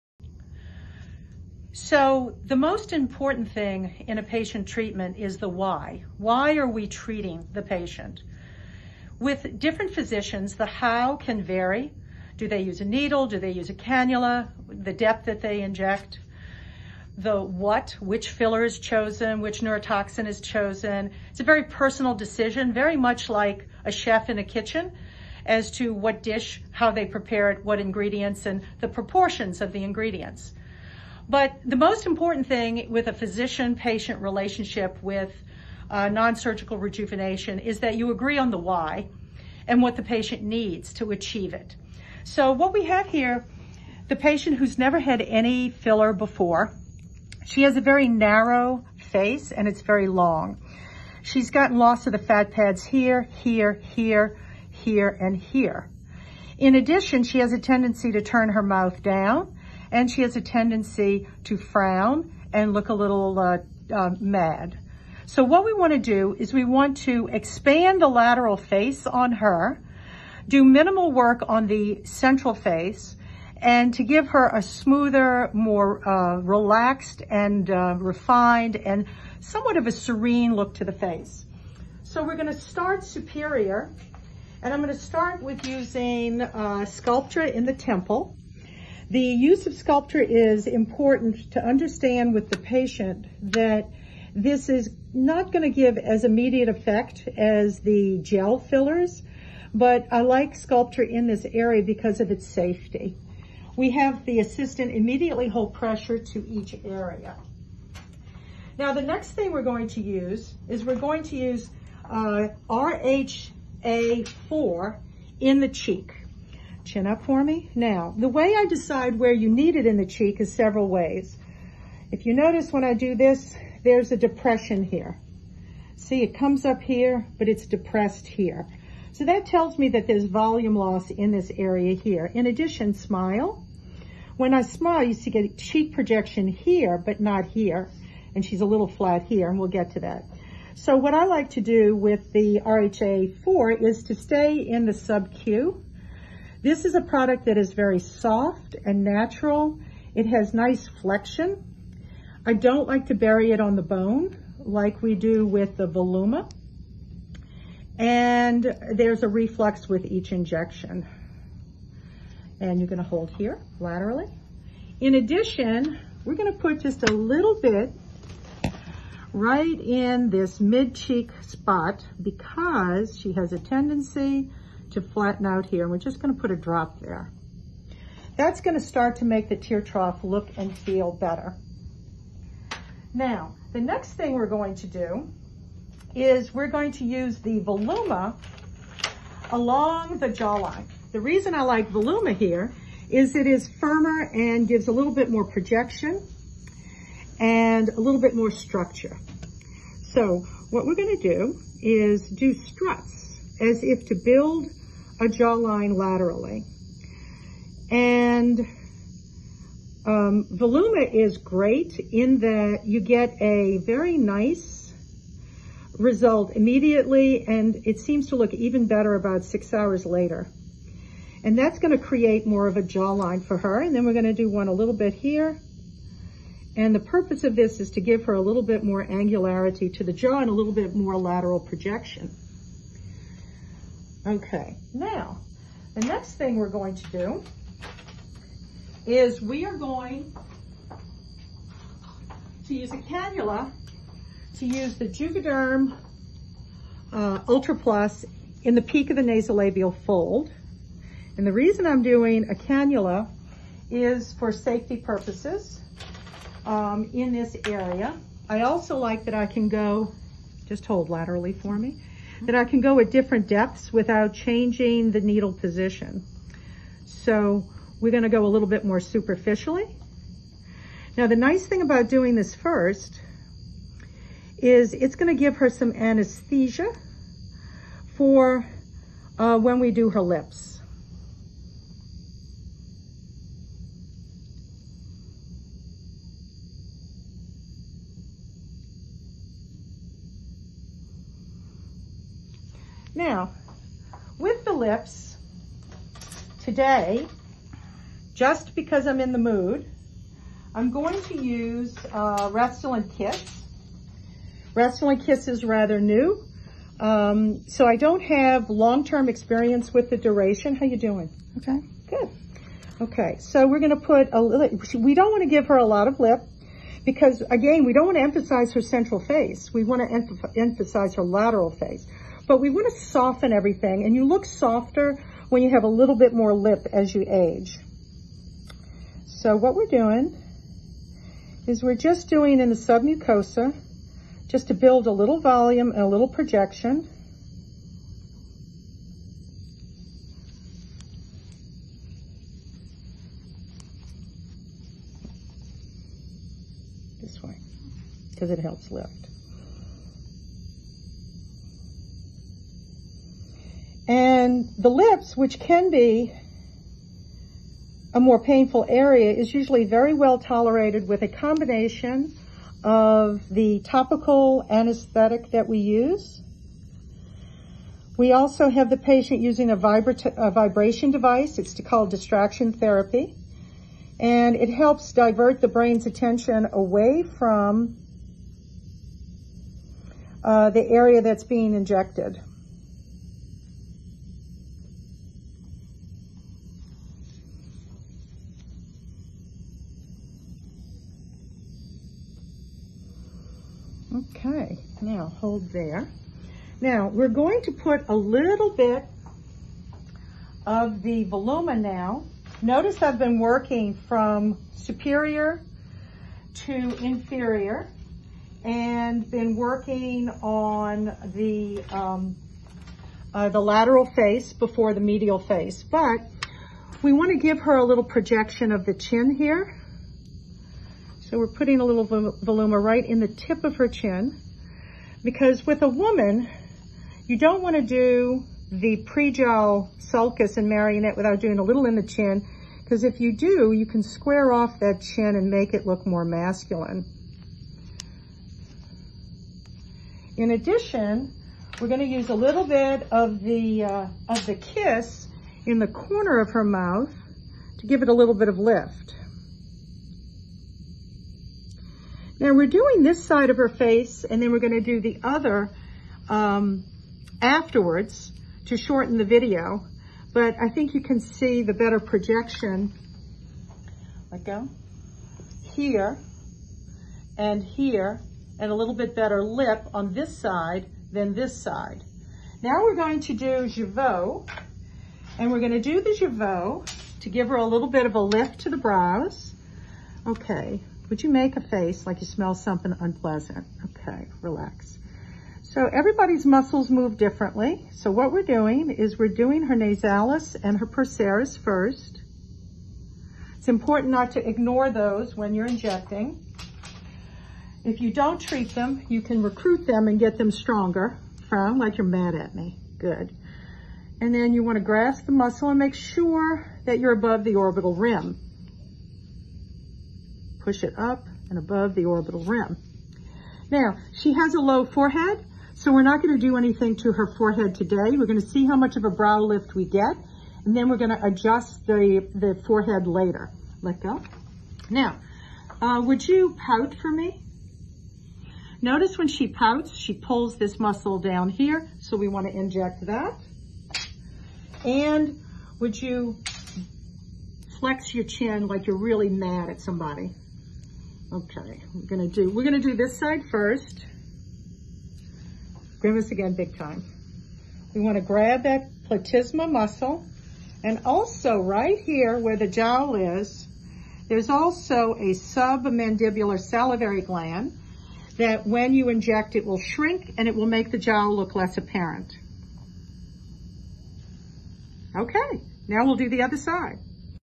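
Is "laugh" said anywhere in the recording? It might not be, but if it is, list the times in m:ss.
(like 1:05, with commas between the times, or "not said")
not said.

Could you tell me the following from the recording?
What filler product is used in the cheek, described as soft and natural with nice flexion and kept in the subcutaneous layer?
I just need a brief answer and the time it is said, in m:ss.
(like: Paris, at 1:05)
RHA4, at 1:52.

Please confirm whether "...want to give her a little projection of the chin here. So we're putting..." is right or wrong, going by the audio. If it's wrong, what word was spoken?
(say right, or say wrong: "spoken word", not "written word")
right.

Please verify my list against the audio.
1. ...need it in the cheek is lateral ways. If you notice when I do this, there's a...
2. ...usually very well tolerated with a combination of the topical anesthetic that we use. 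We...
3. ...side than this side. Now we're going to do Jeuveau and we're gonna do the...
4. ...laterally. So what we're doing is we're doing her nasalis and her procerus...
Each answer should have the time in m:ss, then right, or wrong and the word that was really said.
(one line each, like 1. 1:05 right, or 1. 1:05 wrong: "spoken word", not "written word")
1. 1:59 wrong: "several", not "lateral"
2. 5:59 right
3. 7:50 right
4. 8:07 wrong: "differently", not "laterally".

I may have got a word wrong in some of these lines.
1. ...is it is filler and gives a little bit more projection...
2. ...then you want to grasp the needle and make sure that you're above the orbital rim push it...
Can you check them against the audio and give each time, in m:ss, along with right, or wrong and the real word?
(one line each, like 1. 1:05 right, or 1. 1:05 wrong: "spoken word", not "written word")
1. 3:13 wrong: "firmer", not "filler"
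2. 8:24 wrong: "muscle", not "needle".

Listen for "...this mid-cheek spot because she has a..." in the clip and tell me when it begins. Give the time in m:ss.
2:50.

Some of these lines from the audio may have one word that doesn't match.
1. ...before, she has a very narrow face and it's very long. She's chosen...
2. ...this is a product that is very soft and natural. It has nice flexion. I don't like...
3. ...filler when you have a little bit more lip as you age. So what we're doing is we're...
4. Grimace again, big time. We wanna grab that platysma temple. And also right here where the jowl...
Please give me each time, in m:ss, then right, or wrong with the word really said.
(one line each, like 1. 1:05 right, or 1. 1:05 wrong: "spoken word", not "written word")
1. 0:46 wrong: "gotten", not "chosen"
2. 2:26 right
3. 5:24 wrong: "softer", not "filler"
4. 9:06 wrong: "muscle", not "temple".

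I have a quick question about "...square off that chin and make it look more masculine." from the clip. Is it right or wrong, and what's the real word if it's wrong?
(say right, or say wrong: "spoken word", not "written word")
right.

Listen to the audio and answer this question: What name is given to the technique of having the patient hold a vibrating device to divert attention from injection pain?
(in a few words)
distraction therapy.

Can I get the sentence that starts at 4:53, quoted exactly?
Now, with the lips, today, just because I'm in the mood, I'm going to use uh, Restylane Kysse.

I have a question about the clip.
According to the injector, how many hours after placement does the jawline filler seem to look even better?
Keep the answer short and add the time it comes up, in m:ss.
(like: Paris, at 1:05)
6, at 3:39.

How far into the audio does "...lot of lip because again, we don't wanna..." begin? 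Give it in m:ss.
5:15.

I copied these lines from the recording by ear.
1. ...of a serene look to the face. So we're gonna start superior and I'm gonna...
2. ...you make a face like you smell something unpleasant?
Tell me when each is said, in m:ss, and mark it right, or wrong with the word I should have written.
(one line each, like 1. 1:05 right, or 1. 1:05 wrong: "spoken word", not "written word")
1. 1:19 right
2. 8:01 right.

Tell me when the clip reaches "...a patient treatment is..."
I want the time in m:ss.
0:04.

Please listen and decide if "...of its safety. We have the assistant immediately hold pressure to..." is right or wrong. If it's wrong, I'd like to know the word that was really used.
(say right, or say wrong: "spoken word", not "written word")
right.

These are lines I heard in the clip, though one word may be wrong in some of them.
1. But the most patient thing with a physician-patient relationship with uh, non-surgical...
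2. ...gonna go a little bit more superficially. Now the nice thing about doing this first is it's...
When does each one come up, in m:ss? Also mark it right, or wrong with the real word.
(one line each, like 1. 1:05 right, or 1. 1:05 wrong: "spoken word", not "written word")
1. 0:31 wrong: "important", not "patient"
2. 4:28 right.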